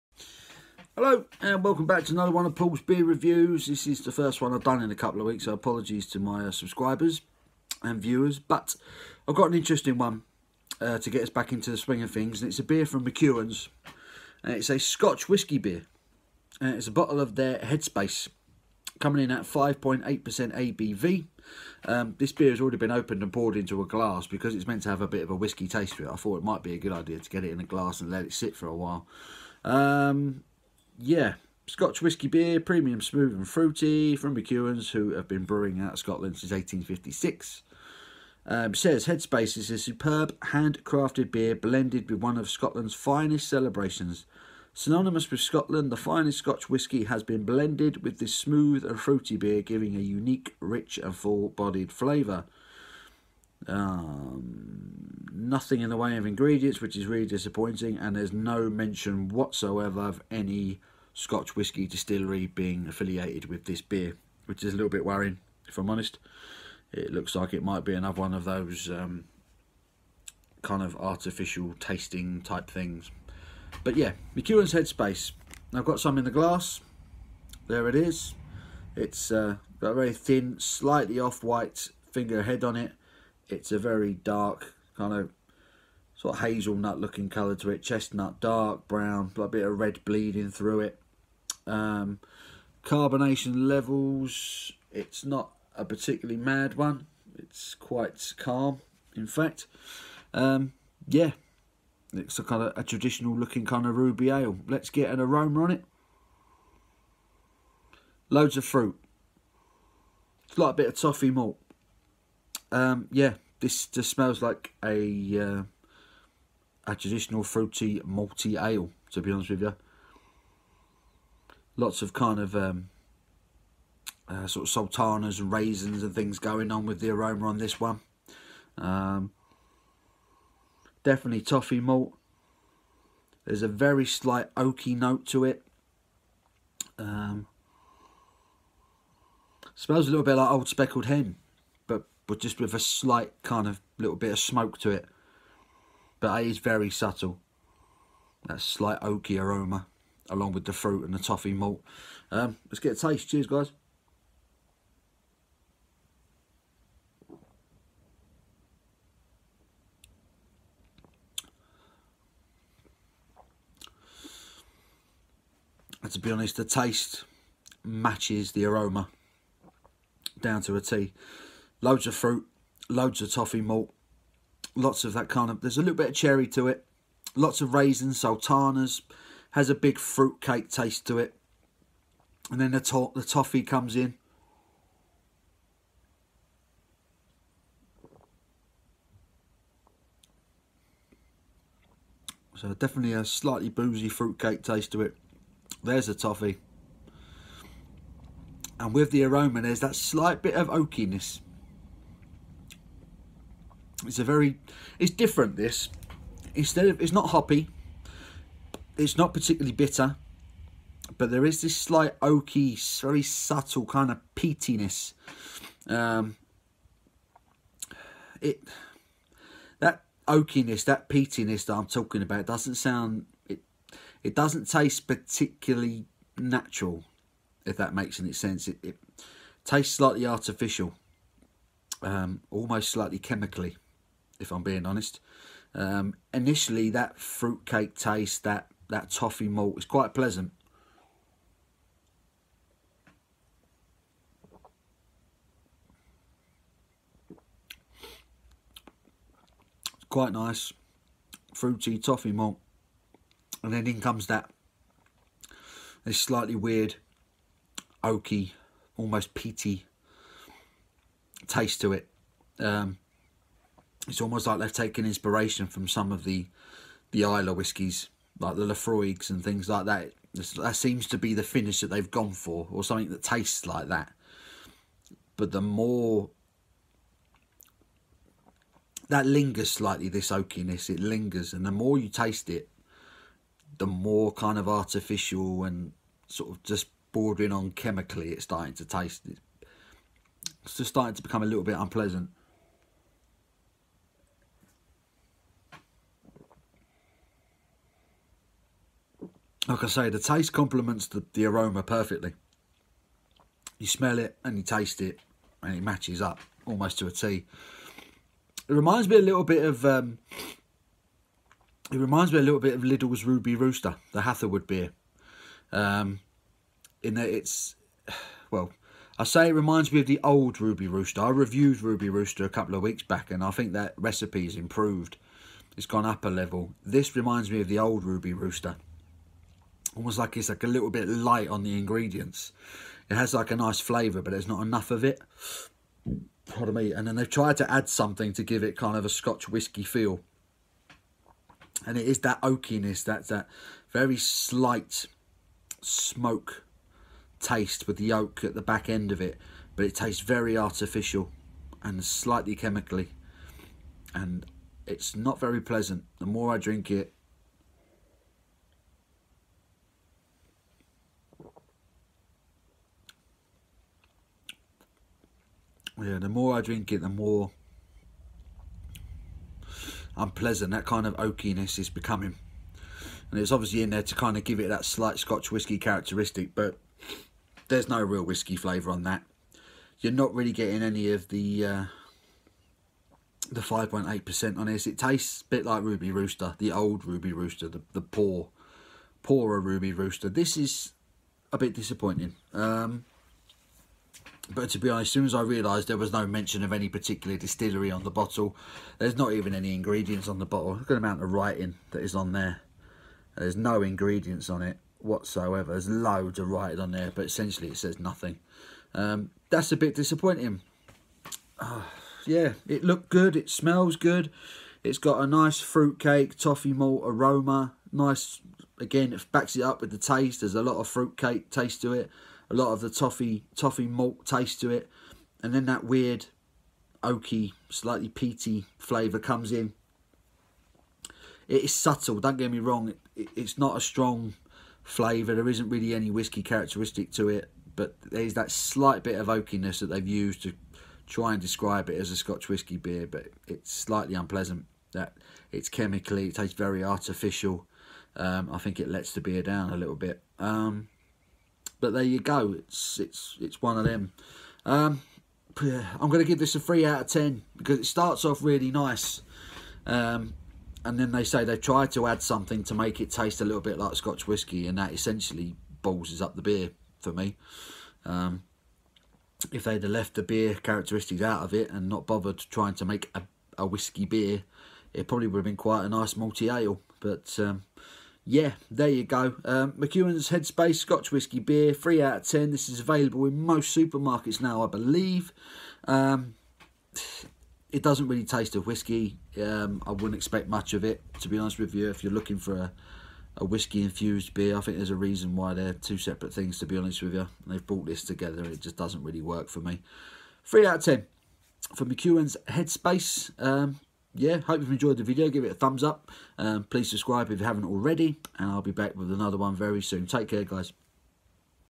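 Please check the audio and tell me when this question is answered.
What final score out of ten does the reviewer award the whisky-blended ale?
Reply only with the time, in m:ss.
7:36.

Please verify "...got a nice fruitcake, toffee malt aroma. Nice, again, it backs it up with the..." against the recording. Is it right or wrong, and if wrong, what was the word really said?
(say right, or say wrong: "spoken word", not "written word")
right.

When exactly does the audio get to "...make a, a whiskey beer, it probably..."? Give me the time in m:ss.
7:52.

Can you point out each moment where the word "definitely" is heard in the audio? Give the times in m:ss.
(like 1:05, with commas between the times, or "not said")
2:11, 3:12.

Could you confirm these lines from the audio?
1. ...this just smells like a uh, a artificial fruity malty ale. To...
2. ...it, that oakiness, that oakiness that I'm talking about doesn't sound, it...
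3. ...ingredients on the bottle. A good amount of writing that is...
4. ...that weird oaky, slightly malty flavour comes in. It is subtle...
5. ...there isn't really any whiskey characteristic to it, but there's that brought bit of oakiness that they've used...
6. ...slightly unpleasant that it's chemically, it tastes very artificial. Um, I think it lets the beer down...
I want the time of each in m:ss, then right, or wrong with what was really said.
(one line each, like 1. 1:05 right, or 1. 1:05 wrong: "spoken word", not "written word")
1. 1:53 wrong: "traditional", not "artificial"
2. 3:38 wrong: "peatiness", not "oakiness"
3. 6:39 right
4. 7:05 wrong: "peaty", not "malty"
5. 7:15 wrong: "slight", not "brought"
6. 7:23 right.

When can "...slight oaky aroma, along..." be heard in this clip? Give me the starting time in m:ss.
2:28.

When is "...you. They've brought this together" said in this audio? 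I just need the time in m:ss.
8:17.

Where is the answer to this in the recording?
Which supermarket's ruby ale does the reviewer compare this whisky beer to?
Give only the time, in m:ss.
5:12.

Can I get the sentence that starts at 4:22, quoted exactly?
Um, it's almost like they've taken inspiration from some of the the Islay whiskies, like the Laphroaigs and things like that.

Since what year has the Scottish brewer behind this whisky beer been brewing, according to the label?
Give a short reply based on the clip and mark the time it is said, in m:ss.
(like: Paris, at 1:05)
1856, at 0:36.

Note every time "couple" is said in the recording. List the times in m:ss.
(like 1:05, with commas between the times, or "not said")
0:04, 5:22.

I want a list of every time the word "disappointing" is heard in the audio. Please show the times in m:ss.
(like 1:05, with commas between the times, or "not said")
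0:57, 6:31, 6:49.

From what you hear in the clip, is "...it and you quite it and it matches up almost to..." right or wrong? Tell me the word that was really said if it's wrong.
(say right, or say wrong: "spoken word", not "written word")
wrong: "taste", not "quite".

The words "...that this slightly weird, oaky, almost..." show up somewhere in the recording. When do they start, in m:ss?
4:14.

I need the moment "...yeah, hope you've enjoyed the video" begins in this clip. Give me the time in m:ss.
8:24.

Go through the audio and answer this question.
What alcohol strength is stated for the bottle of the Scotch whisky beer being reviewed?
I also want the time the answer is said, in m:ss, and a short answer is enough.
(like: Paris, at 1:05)
5.8%, at 0:19.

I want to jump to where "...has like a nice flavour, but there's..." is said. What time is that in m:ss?
5:33.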